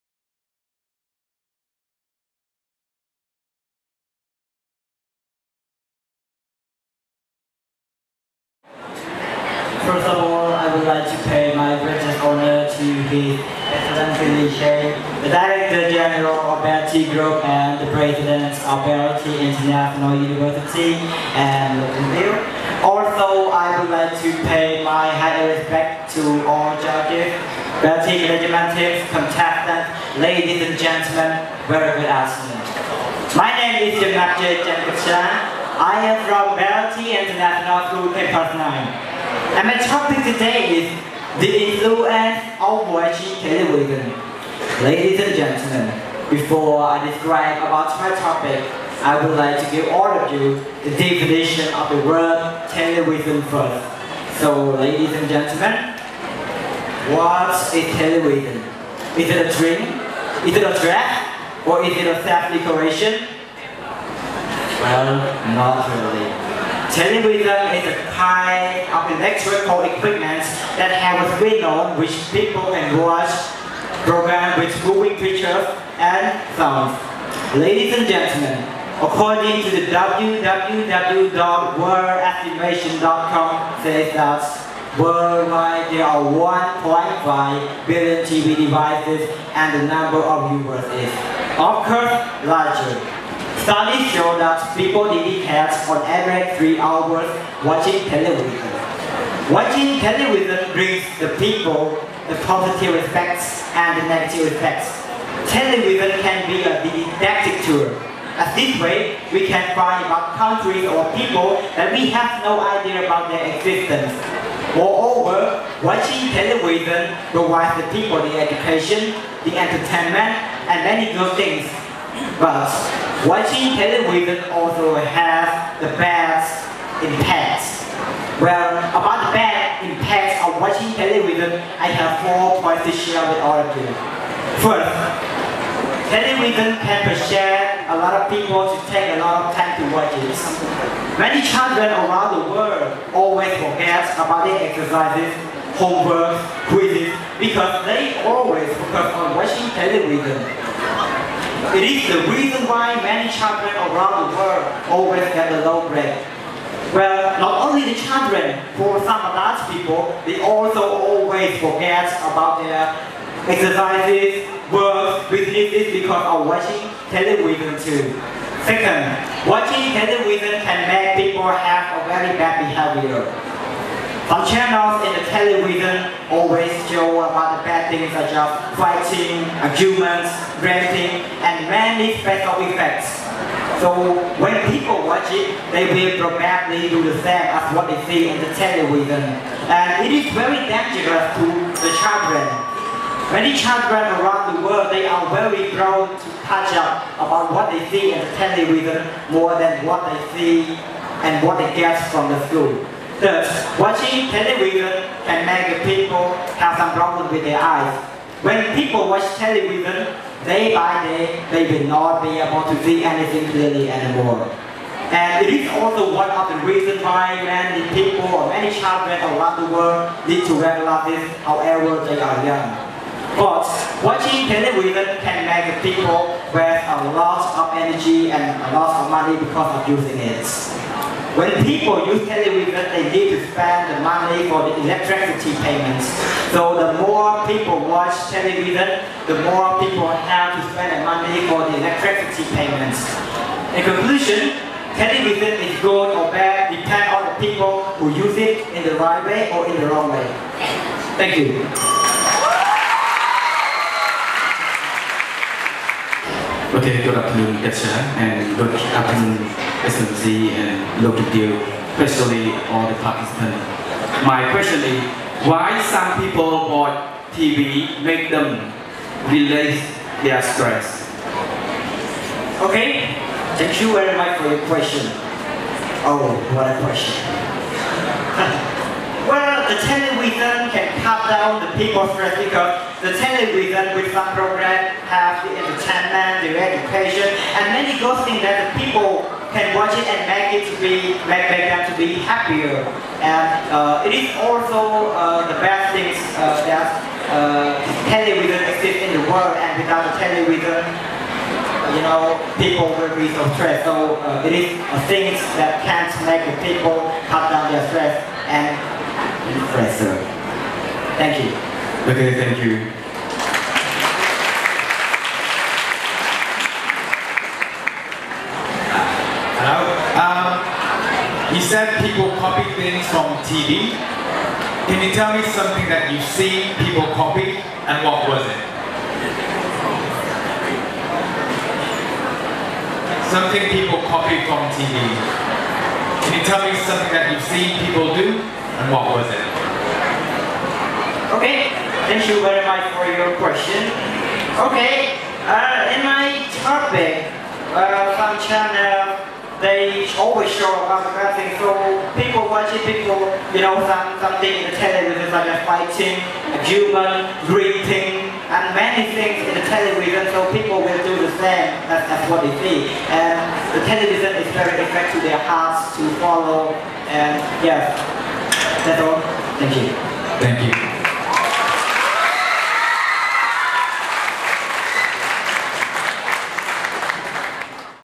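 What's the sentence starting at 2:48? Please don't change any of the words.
Second, watching television can make people have a very bad behavior.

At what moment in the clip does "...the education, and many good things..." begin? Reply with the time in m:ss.
4:46.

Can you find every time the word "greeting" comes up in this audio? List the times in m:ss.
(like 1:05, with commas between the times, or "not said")
5:57.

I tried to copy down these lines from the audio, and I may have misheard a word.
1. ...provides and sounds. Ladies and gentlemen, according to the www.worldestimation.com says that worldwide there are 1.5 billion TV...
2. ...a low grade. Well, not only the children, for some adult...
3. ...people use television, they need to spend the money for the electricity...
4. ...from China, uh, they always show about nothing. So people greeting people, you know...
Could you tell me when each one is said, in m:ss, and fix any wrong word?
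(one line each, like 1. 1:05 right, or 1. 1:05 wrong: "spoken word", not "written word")
1. 1:15 wrong: "pictures", not "provides"
2. 2:35 right
3. 3:51 right
4. 5:48 wrong: "watching", not "greeting".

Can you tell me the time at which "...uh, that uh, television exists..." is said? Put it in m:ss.
4:56.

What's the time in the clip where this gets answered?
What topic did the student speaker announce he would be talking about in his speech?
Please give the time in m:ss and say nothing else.
0:41.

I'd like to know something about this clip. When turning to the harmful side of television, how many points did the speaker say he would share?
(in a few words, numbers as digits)
4.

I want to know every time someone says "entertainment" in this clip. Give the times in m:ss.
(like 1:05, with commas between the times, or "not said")
1:59, 4:45.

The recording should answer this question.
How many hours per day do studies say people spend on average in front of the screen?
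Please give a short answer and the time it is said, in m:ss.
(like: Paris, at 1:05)
3 hours, at 1:36.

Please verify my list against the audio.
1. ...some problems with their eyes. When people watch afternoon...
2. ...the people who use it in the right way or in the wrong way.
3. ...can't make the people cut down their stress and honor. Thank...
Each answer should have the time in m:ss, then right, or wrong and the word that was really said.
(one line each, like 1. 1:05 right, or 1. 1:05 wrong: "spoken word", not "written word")
1. 3:26 wrong: "television", not "afternoon"
2. 4:07 right
3. 5:05 wrong: "depressor", not "honor".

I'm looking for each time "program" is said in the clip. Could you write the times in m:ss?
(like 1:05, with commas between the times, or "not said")
1:14, 4:44.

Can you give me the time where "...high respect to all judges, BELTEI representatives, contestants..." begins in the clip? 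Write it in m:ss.
0:25.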